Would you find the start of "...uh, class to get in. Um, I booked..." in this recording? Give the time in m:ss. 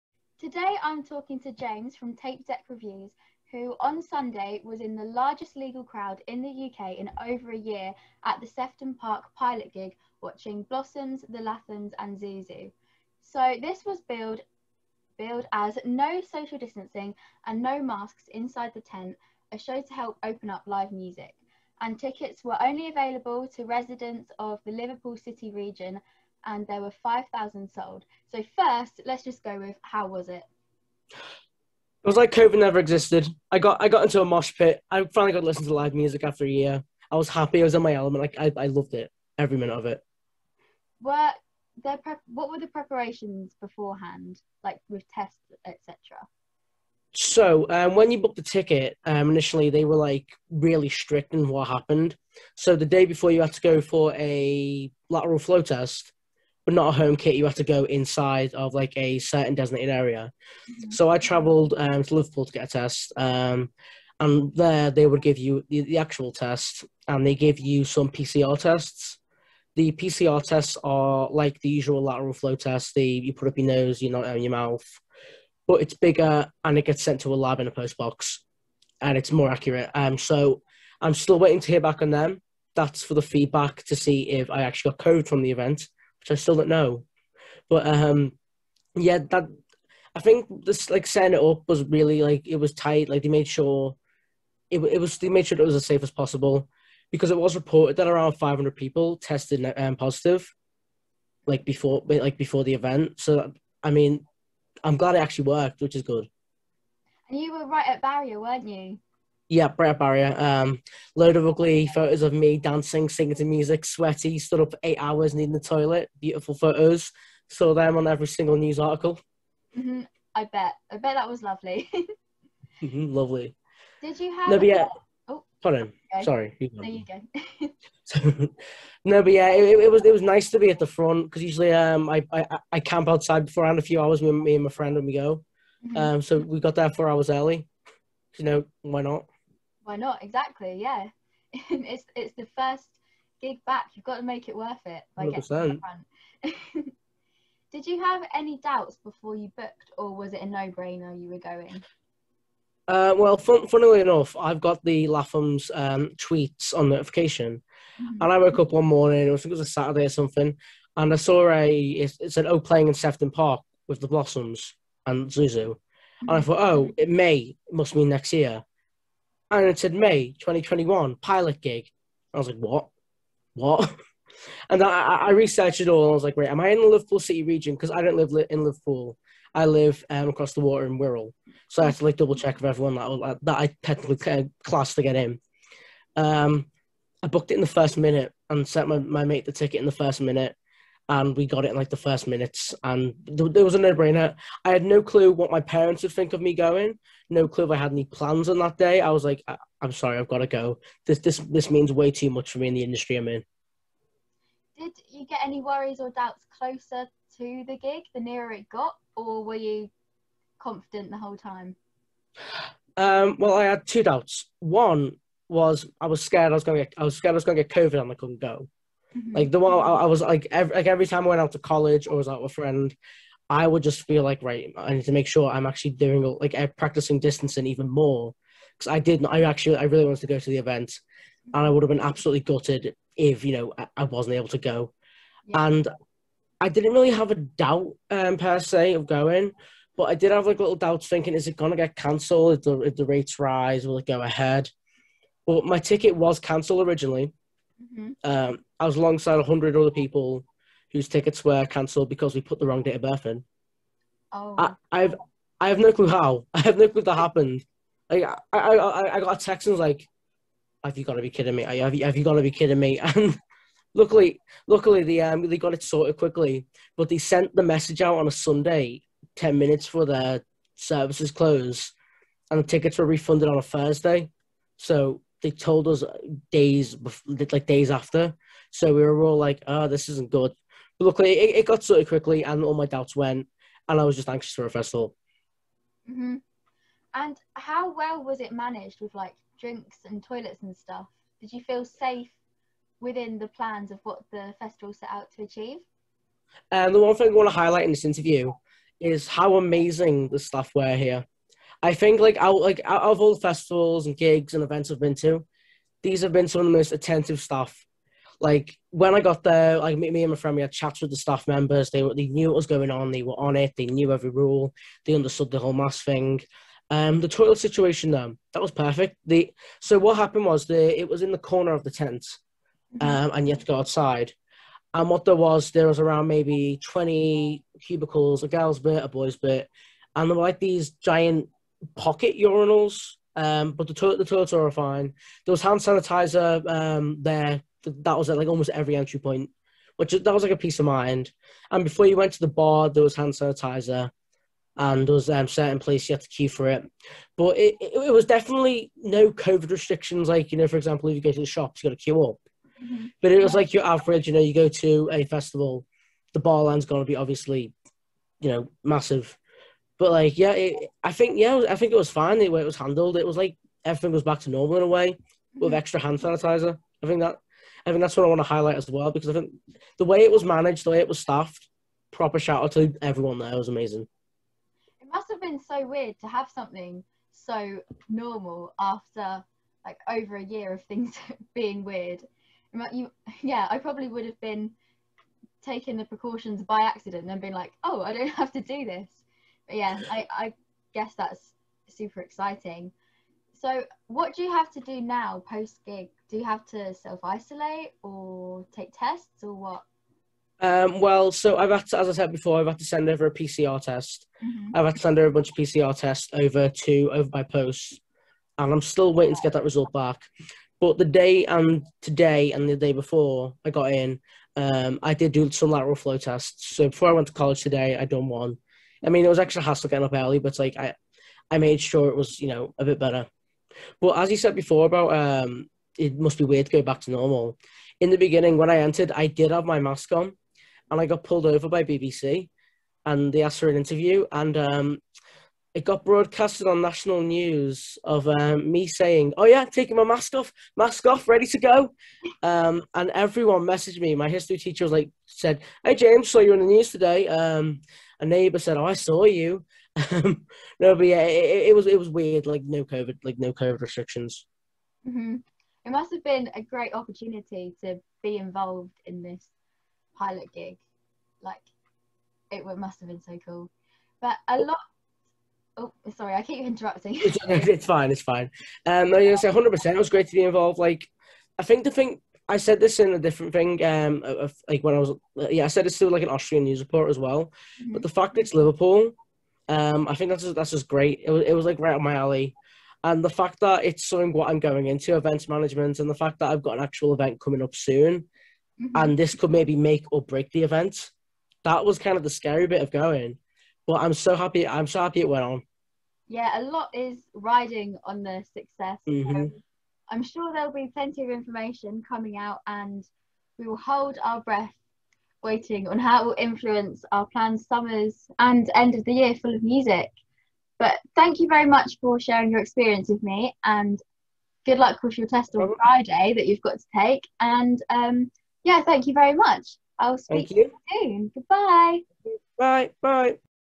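3:04.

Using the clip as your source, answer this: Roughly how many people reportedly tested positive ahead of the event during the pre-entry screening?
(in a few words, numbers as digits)
500.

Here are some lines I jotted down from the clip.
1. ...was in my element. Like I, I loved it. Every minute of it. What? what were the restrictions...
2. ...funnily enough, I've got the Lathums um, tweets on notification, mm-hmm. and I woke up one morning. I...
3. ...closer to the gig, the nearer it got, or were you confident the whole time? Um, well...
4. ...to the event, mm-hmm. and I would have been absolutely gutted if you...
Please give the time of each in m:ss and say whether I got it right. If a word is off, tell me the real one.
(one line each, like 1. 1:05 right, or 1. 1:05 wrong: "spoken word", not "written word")
1. 0:37 wrong: "preparations", not "restrictions"
2. 2:33 right
3. 3:26 right
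4. 3:50 right.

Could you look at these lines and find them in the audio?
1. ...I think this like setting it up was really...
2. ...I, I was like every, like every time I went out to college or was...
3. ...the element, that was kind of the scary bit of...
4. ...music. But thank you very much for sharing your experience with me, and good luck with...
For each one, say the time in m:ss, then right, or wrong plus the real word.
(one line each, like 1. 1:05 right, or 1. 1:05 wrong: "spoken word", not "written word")
1. 1:30 right
2. 3:39 right
3. 8:10 wrong: "event", not "element"
4. 8:29 right.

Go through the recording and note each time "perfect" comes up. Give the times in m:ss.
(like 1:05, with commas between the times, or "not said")
5:18.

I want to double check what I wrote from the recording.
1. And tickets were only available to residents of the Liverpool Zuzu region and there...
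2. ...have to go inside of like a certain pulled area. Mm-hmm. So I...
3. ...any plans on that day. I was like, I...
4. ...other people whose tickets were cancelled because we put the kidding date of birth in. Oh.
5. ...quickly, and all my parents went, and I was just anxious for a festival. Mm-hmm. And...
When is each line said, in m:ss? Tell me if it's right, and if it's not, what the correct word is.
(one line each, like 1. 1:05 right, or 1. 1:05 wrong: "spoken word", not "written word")
1. 0:21 wrong: "City", not "Zuzu"
2. 0:57 wrong: "designated", not "pulled"
3. 3:17 right
4. 4:09 wrong: "wrong", not "kidding"
5. 4:42 wrong: "doubts", not "parents".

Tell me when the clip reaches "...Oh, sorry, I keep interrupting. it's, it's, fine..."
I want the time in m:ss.
7:45.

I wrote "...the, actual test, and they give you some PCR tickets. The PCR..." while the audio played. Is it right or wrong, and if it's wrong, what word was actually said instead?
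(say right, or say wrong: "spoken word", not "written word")
wrong: "tests", not "tickets".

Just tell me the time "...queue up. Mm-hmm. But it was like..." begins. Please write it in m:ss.
5:52.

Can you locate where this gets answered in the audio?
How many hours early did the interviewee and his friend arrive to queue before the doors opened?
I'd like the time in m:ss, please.
2:16.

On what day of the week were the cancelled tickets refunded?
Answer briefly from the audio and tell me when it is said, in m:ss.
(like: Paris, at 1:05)
Thursday, at 4:33.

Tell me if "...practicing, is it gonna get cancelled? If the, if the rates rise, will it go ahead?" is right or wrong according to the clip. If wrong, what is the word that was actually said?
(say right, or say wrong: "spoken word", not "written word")
wrong: "thinking", not "practicing".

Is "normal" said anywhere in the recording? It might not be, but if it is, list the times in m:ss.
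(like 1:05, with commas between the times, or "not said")
6:04, 6:18, 7:07.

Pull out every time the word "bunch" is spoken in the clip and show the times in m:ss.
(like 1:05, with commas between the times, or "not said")
6:45.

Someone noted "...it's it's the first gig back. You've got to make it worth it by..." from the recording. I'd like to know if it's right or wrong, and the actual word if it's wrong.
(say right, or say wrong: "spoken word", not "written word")
right.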